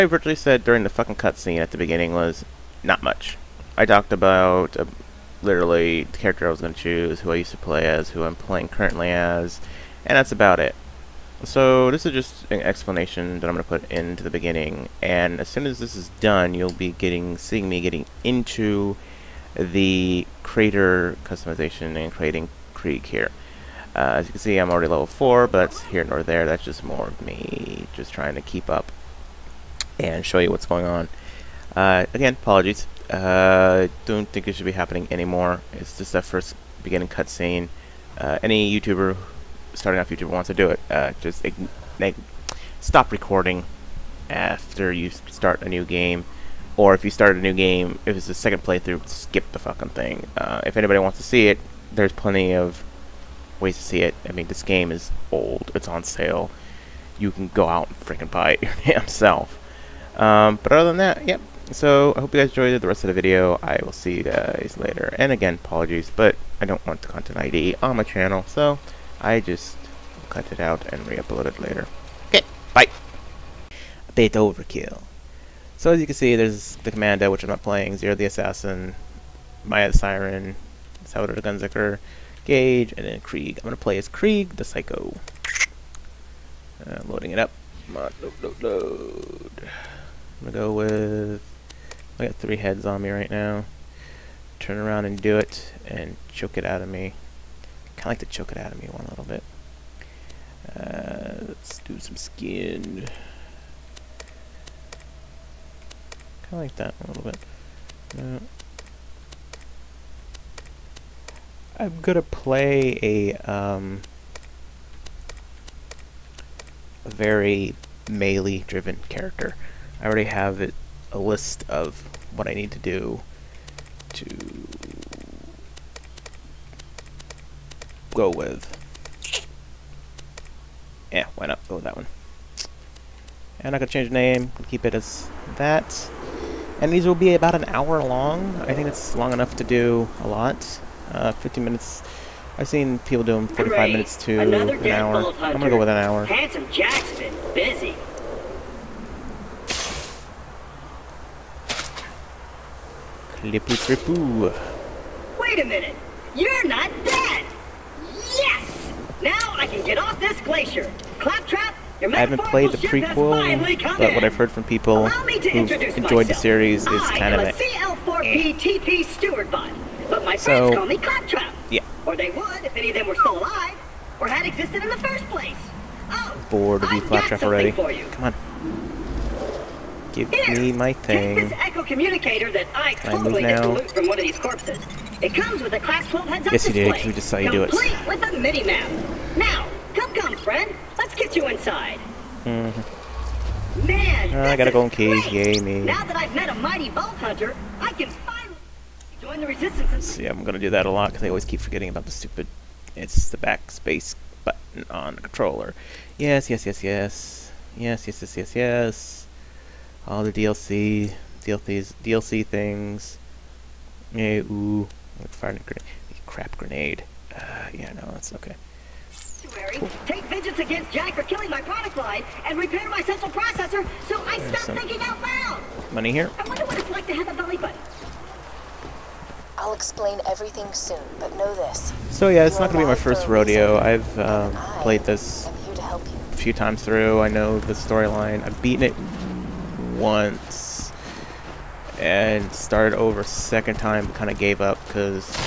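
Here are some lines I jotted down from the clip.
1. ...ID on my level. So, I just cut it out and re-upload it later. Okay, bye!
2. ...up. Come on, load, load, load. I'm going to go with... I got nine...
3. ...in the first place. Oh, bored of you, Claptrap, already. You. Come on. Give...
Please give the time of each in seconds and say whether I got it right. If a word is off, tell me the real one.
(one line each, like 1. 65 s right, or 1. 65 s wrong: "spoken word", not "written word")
1. 67 s wrong: "channel", not "level"
2. 87 s wrong: "three", not "nine"
3. 174 s right.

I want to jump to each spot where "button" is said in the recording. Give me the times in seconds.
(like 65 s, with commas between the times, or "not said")
204 s, 227 s.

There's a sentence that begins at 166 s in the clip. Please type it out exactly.
the series is I kind of a CL4PTP eh.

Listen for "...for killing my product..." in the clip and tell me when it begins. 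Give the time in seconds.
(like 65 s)
221 s.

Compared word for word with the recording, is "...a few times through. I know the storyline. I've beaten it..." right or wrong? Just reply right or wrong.
right.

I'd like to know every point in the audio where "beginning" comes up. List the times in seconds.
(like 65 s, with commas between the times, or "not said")
1 s, 14 s, 36 s.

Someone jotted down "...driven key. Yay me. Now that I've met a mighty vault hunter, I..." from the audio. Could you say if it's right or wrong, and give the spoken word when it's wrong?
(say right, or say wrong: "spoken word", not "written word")
wrong: "golden", not "driven".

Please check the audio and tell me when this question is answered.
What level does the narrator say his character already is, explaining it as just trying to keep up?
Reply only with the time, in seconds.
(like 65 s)
24 s.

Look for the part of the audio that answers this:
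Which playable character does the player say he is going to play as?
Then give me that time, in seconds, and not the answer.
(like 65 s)
84 s.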